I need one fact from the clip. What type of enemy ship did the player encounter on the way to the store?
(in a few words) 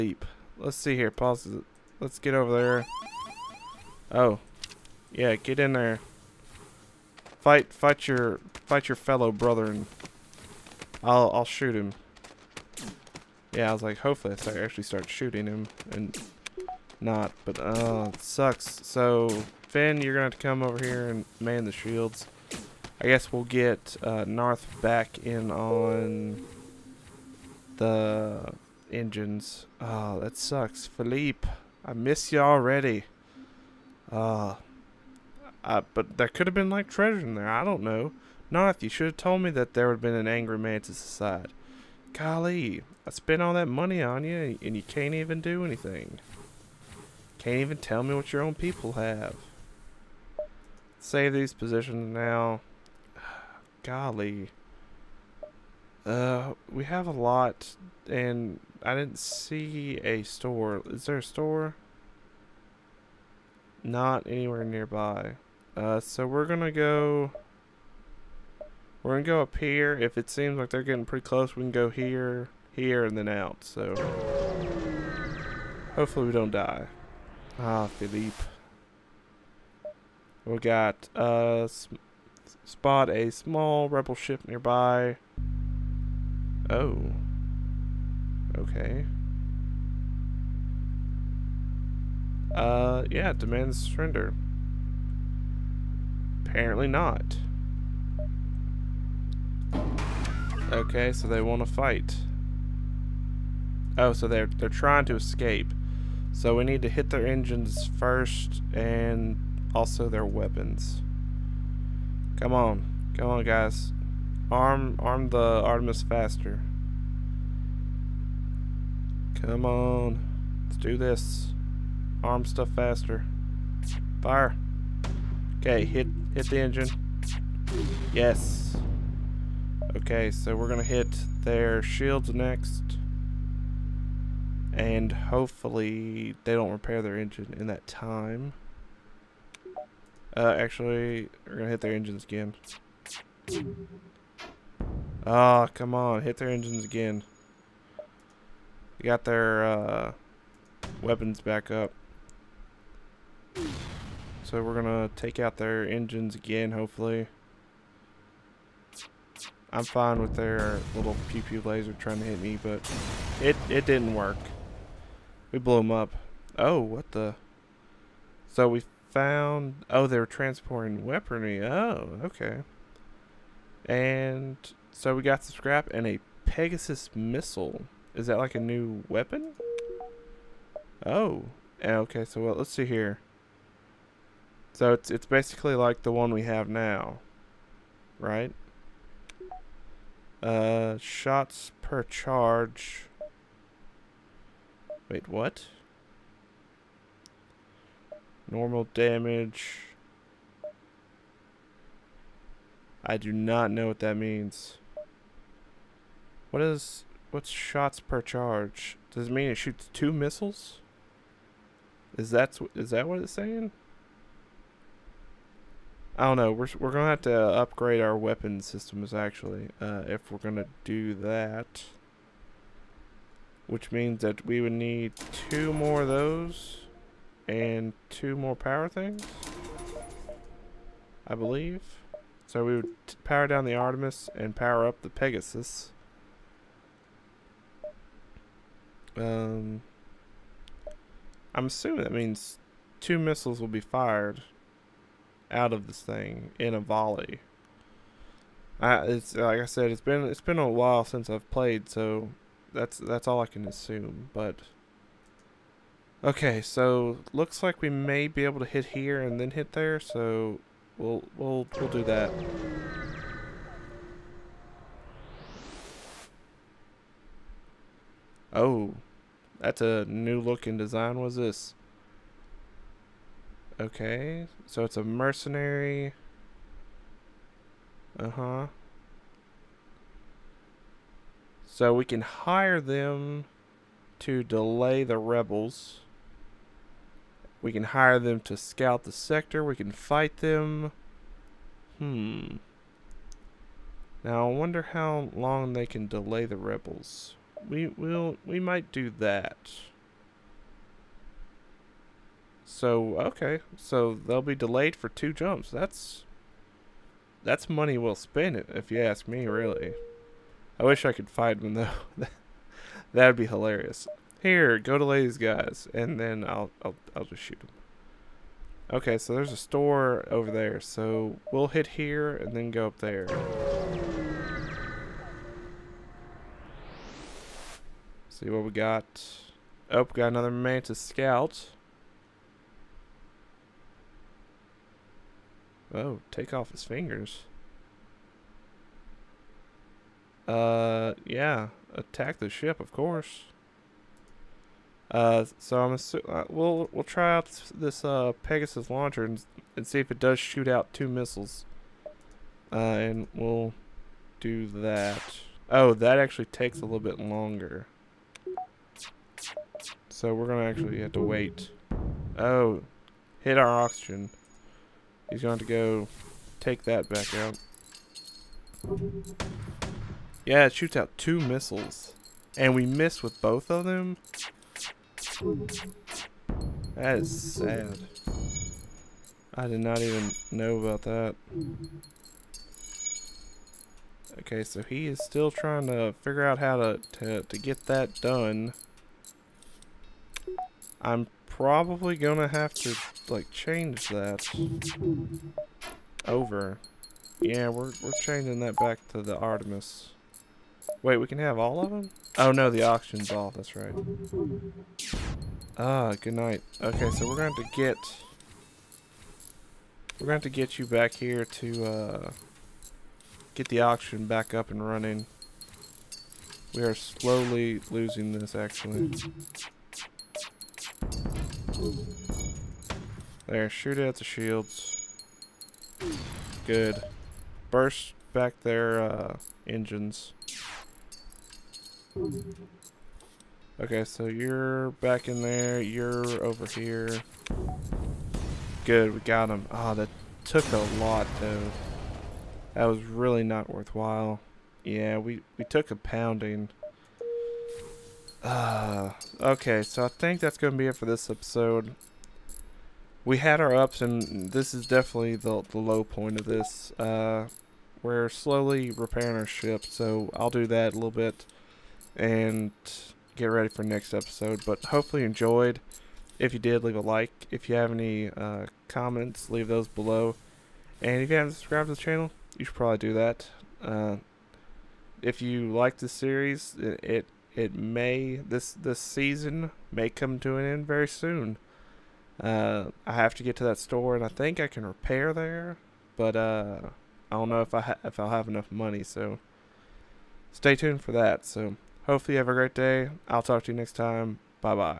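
Mantis Scout.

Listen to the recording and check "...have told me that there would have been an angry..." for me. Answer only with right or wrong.
right.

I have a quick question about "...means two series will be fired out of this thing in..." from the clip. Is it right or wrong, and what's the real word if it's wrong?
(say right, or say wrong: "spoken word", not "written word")
wrong: "missiles", not "series".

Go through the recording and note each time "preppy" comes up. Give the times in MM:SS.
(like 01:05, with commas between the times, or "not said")
not said.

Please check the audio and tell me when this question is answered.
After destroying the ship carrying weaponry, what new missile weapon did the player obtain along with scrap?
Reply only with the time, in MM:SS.
02:56.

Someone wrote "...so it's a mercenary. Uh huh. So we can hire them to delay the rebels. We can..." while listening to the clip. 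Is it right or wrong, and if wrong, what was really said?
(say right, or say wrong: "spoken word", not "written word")
right.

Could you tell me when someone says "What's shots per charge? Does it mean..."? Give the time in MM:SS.
03:27.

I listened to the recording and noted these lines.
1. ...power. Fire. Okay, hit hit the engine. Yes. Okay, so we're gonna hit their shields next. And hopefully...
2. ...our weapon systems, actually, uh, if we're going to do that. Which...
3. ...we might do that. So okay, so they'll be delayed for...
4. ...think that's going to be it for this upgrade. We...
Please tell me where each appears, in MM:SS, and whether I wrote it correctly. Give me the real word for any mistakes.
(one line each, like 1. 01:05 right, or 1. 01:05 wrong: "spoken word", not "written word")
1. 02:02 wrong: "faster", not "power"
2. 03:38 right
3. 04:58 right
4. 07:30 wrong: "episode", not "upgrade".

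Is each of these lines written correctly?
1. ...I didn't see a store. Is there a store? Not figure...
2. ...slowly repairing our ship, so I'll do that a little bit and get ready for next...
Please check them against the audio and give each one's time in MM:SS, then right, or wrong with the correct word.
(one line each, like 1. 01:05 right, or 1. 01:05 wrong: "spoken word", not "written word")
1. 00:58 wrong: "anywhere", not "figure"
2. 07:38 right.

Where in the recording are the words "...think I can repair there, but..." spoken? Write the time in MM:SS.
08:04.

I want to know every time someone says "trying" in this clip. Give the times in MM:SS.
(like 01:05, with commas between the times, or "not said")
01:44, 02:41, 06:25.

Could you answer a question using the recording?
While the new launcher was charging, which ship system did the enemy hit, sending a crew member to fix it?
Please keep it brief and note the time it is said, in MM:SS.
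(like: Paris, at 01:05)
oxygen, at 06:03.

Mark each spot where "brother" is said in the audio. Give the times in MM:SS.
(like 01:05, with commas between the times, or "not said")
00:09.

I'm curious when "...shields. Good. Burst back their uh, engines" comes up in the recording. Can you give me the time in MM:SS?
07:04.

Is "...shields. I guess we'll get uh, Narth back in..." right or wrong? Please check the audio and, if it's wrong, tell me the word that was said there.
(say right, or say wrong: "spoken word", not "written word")
right.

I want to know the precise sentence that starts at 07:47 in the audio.
If you have any uh, comments, leave those below.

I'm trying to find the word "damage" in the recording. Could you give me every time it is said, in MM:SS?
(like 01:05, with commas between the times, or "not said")
03:18.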